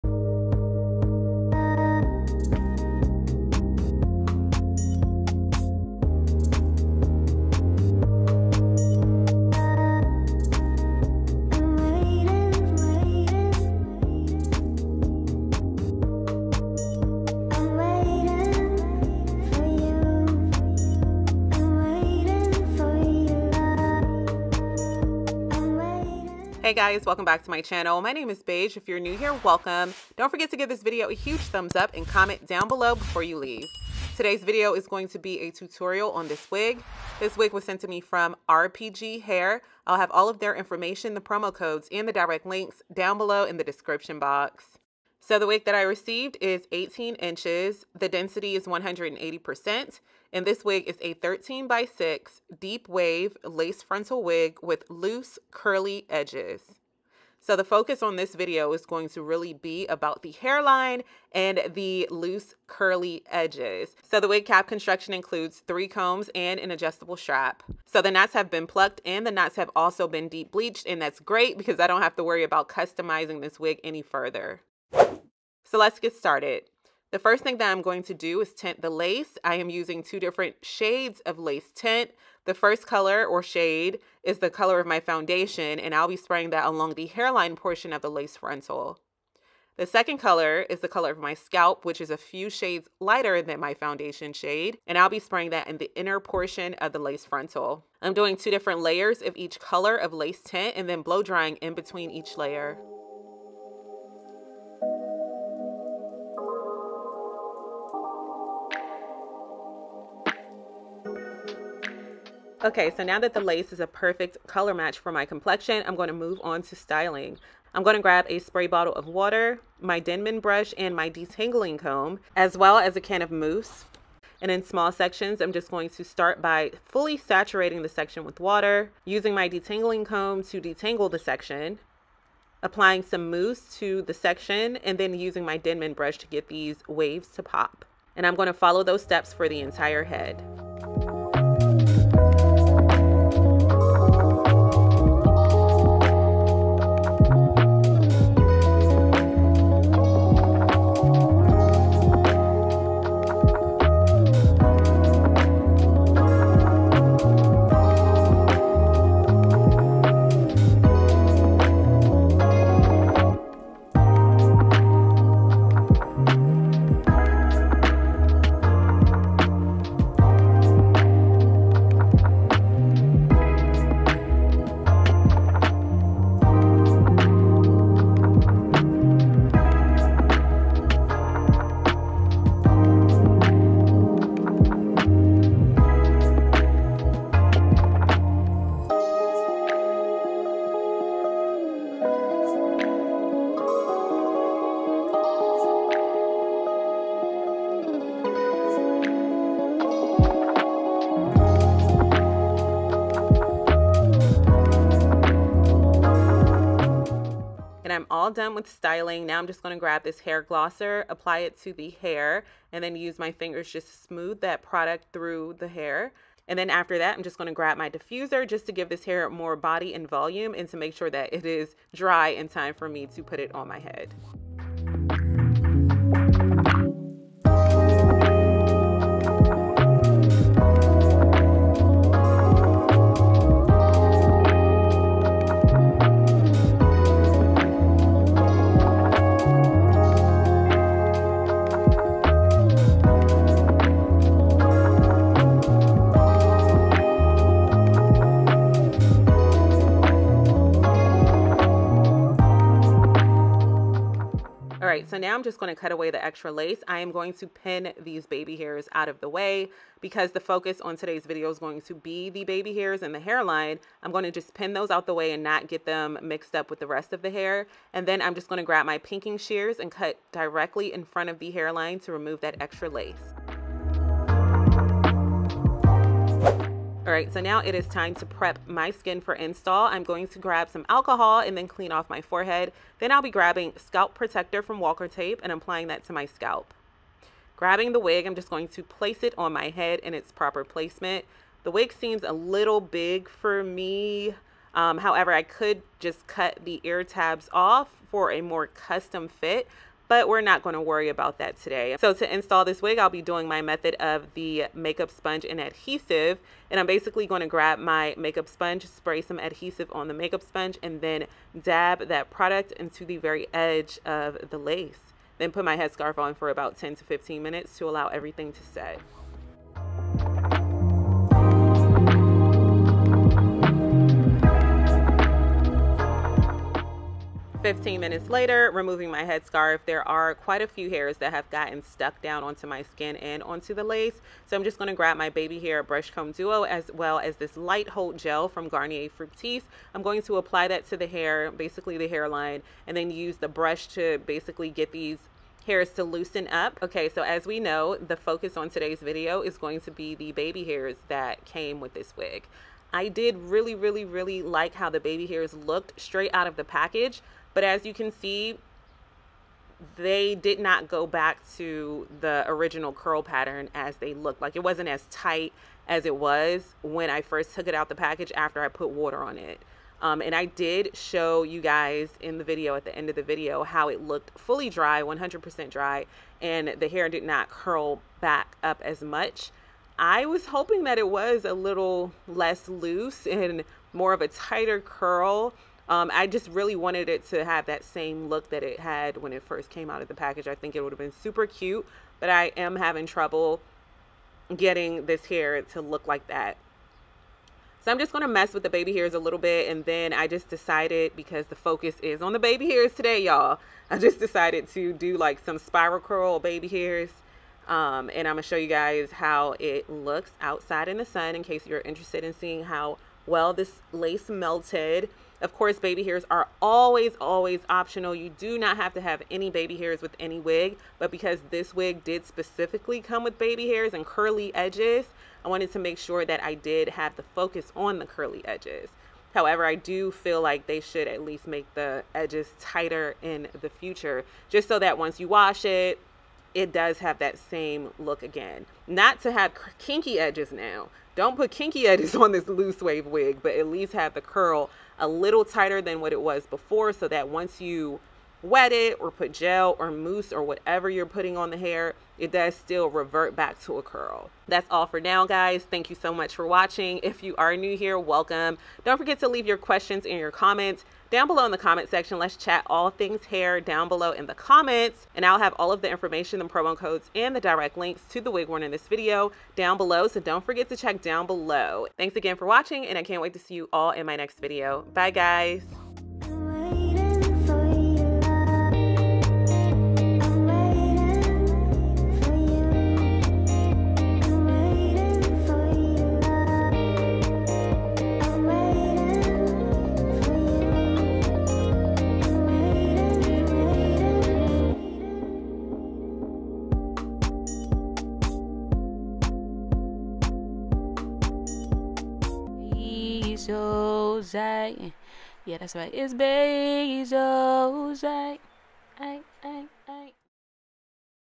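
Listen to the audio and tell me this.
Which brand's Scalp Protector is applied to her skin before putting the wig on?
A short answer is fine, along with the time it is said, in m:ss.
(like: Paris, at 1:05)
Walker Tape, at 4:44.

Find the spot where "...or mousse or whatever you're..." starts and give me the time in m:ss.
7:29.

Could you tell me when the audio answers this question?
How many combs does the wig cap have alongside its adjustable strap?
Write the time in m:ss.
1:05.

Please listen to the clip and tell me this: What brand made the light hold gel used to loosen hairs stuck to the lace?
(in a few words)
Garnier Fructis.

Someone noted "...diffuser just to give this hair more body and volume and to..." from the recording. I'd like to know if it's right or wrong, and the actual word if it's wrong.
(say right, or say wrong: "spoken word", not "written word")
right.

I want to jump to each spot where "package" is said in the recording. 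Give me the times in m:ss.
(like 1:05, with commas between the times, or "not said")
5:56, 6:07, 6:30.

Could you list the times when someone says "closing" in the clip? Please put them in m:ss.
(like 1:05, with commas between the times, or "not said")
not said.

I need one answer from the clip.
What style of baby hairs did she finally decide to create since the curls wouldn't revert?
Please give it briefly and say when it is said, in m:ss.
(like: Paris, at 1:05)
Spiral curl baby hairs, at 6:45.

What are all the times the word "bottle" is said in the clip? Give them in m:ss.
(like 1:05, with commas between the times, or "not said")
1:58.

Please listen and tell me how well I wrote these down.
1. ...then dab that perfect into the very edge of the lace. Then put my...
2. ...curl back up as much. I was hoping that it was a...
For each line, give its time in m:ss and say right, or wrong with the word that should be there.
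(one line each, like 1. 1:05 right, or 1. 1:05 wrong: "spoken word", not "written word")
1. 5:10 wrong: "product", not "perfect"
2. 6:17 right.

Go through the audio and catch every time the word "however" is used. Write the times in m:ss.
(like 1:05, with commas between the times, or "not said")
4:54, 7:09.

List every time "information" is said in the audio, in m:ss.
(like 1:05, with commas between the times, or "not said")
0:40, 7:45.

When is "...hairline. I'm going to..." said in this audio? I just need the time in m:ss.
4:23.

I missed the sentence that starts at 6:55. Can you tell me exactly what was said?
Of course, baby hairs are always, always optional.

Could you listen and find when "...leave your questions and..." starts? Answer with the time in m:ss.
7:39.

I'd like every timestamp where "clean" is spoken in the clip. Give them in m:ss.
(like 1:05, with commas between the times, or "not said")
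4:41.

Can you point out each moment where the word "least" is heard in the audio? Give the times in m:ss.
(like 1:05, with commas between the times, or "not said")
7:11, 7:23.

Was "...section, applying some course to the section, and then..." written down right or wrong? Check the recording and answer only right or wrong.
wrong.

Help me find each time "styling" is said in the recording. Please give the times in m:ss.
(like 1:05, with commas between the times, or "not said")
1:56, 3:28.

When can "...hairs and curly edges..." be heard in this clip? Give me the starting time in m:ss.
7:03.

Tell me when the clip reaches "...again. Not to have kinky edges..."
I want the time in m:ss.
7:18.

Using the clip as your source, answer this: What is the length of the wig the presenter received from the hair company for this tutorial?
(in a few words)
18 inches.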